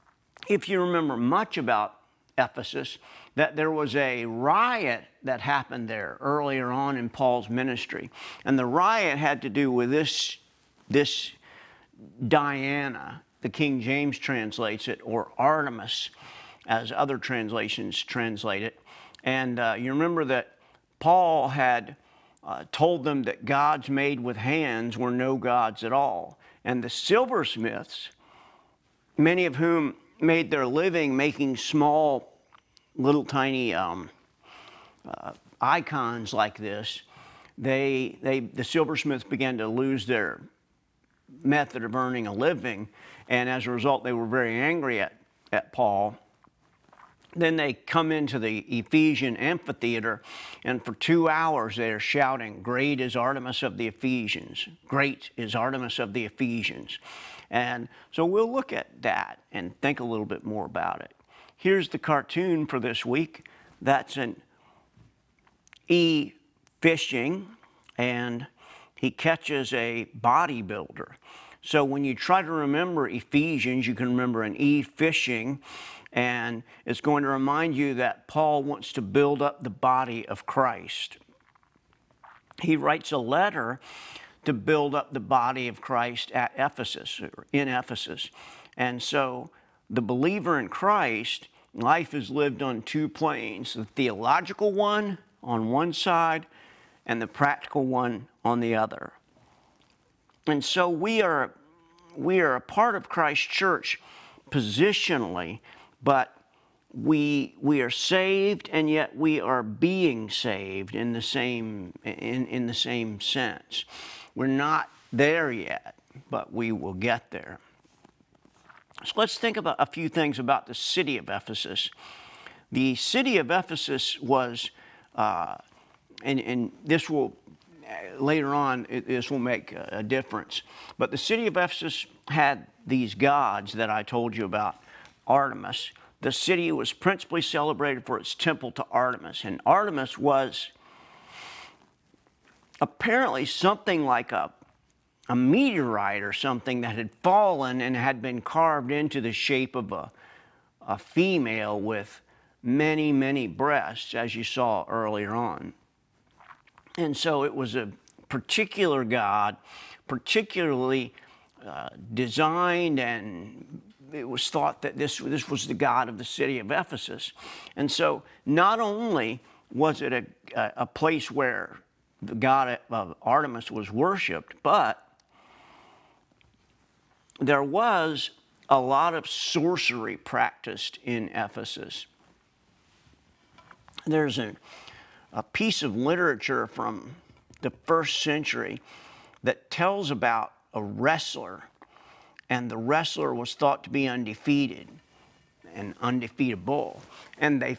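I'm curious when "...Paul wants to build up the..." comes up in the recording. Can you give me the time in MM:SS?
01:18.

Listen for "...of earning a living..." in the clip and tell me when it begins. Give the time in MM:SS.
00:41.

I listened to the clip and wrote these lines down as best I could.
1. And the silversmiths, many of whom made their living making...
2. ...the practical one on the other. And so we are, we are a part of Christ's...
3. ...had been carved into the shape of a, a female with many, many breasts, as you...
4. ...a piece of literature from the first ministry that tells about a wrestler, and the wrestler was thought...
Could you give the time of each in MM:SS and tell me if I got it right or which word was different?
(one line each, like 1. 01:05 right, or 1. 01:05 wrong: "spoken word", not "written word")
1. 00:26 right
2. 01:37 right
3. 02:27 right
4. 03:05 wrong: "century", not "ministry".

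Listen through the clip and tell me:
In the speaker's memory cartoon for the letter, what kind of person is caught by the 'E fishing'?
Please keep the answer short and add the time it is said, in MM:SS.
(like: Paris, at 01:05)
a bodybuilder, at 01:10.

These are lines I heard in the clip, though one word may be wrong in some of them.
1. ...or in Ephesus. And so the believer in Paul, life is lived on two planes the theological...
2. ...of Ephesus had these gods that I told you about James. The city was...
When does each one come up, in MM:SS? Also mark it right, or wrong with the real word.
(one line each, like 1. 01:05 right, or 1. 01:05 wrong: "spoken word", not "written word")
1. 01:27 wrong: "Christ", not "Paul"
2. 02:11 wrong: "Artemis", not "James".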